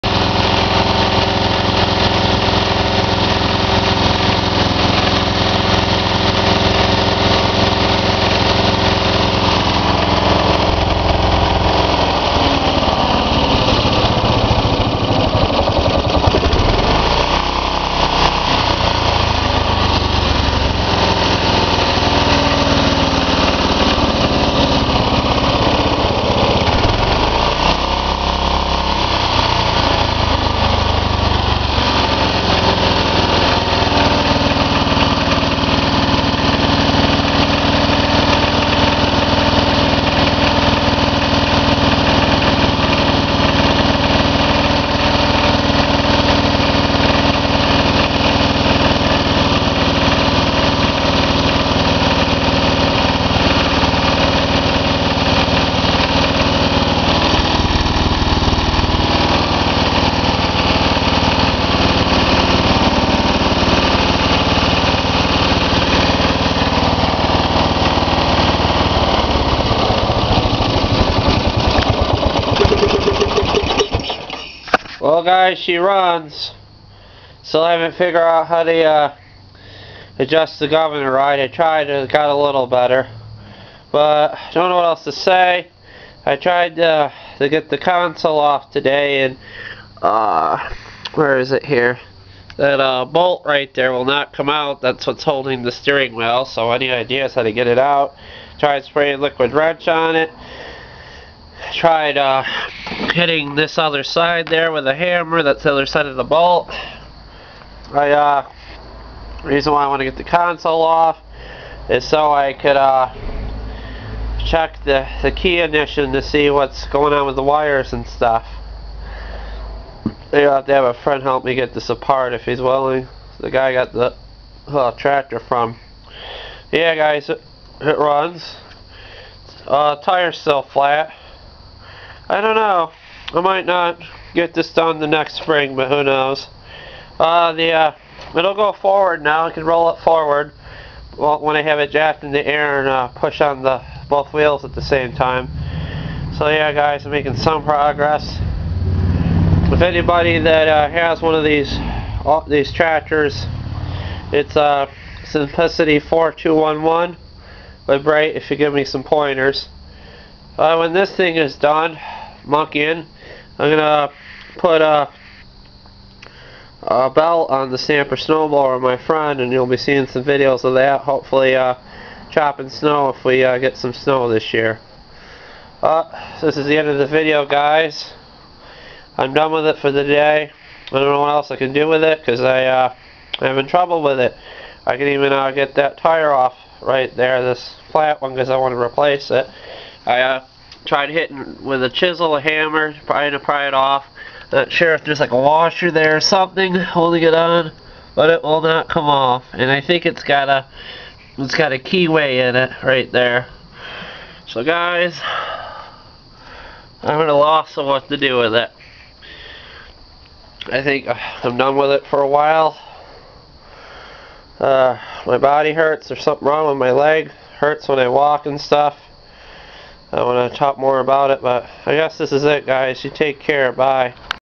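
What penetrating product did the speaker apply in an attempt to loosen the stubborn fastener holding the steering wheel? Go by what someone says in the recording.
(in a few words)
Liquid Wrench.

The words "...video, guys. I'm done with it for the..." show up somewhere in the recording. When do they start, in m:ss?
2:57.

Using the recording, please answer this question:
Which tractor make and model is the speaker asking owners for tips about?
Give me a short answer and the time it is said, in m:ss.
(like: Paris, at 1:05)
Simplicity 4211, at 2:35.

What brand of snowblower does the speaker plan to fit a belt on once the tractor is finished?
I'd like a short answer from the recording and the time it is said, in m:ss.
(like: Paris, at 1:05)
Stamper, at 2:47.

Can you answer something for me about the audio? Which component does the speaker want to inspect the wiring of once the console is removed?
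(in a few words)
Key ignition.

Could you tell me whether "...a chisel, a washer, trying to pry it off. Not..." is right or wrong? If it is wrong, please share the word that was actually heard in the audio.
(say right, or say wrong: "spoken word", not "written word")
wrong: "hammer", not "washer".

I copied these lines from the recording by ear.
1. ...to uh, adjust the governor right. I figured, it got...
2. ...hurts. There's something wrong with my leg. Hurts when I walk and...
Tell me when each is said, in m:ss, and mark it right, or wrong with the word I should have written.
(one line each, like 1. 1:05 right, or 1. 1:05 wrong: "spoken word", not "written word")
1. 1:18 wrong: "tried", not "figured"
2. 3:35 right.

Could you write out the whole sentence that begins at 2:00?
I'll have to have a friend help me get this apart if he's willing.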